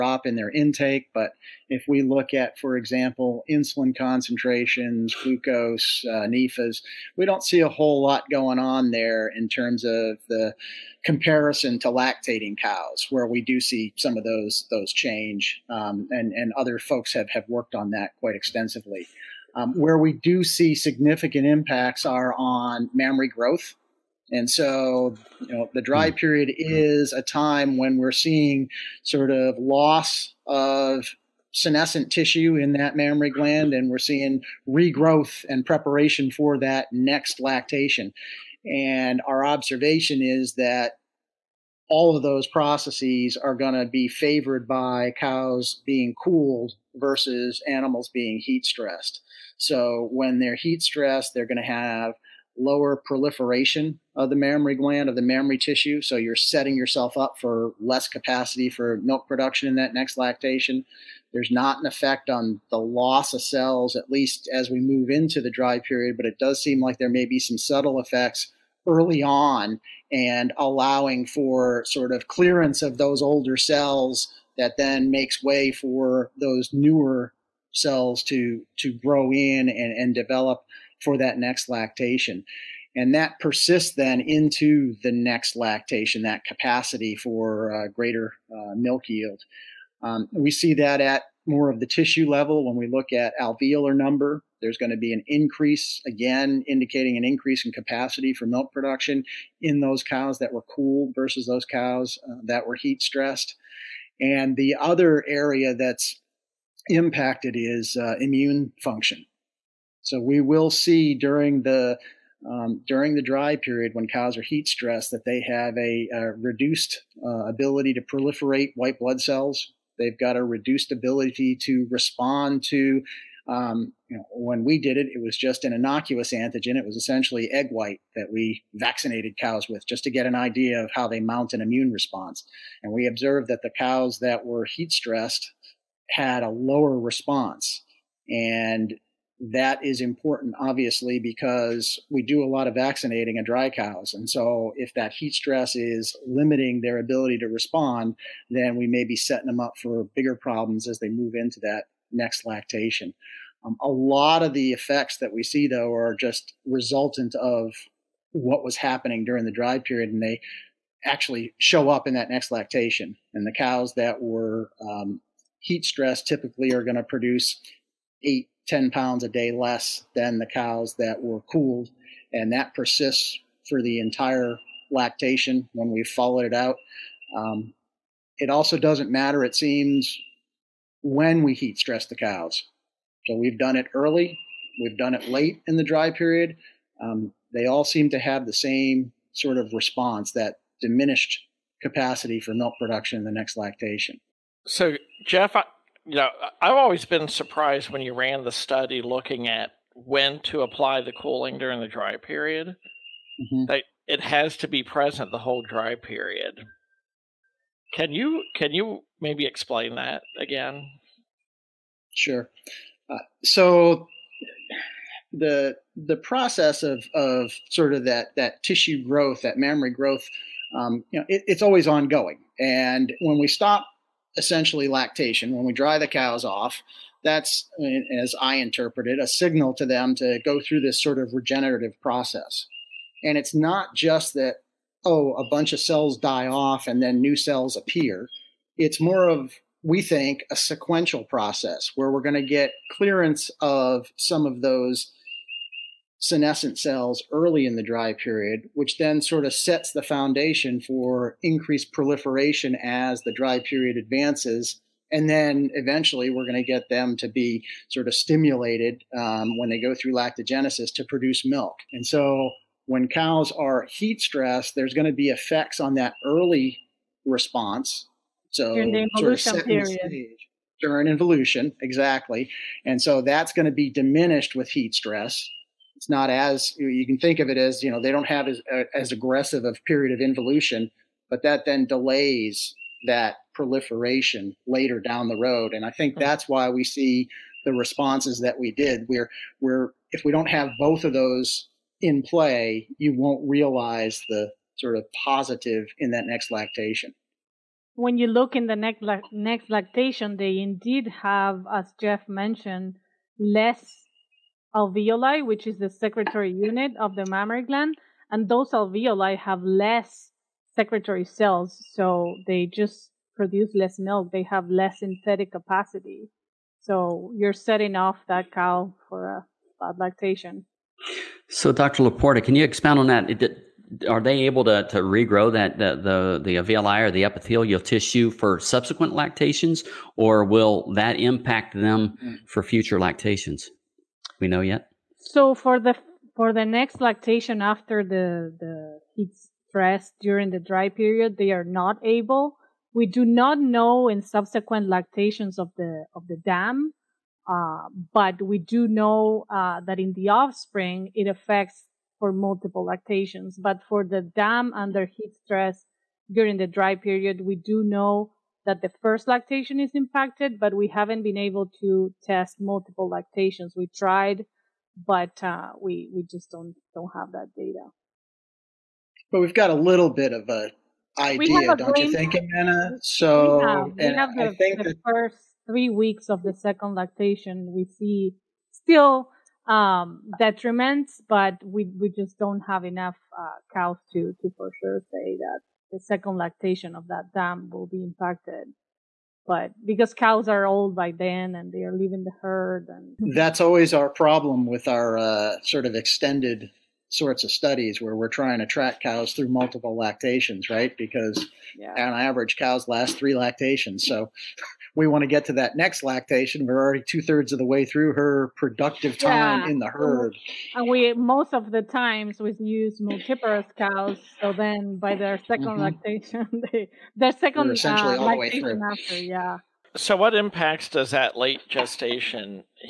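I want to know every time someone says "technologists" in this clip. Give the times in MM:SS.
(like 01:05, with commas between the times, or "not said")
not said.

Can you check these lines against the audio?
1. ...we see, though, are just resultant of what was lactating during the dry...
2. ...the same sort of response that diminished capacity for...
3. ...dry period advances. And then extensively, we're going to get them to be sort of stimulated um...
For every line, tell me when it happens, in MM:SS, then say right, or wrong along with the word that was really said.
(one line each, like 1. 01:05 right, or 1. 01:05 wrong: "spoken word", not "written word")
1. 02:35 wrong: "happening", not "lactating"
2. 03:08 right
3. 04:13 wrong: "eventually", not "extensively".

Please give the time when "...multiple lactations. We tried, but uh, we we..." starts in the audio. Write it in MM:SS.
06:02.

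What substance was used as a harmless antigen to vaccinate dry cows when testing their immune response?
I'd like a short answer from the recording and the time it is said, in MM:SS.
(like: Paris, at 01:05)
egg white, at 02:07.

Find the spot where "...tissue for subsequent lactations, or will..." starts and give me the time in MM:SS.
05:27.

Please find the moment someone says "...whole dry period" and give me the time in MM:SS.
03:25.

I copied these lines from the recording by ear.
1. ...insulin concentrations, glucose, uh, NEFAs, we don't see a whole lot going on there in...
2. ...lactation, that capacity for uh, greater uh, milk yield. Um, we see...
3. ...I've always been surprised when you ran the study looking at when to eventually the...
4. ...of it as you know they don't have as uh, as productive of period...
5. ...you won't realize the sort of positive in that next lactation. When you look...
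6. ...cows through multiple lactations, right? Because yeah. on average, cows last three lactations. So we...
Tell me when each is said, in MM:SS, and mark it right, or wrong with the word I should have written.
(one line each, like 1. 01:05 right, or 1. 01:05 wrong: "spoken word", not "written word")
1. 00:03 right
2. 01:25 right
3. 03:16 wrong: "apply", not "eventually"
4. 04:37 wrong: "aggressive", not "productive"
5. 04:52 right
6. 06:38 right.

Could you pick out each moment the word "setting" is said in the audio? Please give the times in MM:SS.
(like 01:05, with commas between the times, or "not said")
00:56, 02:29, 05:17.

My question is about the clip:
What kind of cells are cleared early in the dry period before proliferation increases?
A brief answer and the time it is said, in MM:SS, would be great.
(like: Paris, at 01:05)
senescent cells, at 04:06.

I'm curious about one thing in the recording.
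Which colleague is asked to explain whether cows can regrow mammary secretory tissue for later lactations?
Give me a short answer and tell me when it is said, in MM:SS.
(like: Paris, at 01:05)
Dr. Laporta, at 05:21.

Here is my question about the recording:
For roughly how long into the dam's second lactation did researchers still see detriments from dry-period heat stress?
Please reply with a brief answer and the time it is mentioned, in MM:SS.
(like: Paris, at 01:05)
first 3 weeks, at 06:15.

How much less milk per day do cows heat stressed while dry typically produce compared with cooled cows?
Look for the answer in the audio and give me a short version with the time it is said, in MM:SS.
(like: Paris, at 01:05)
8 to 10 pounds, at 02:48.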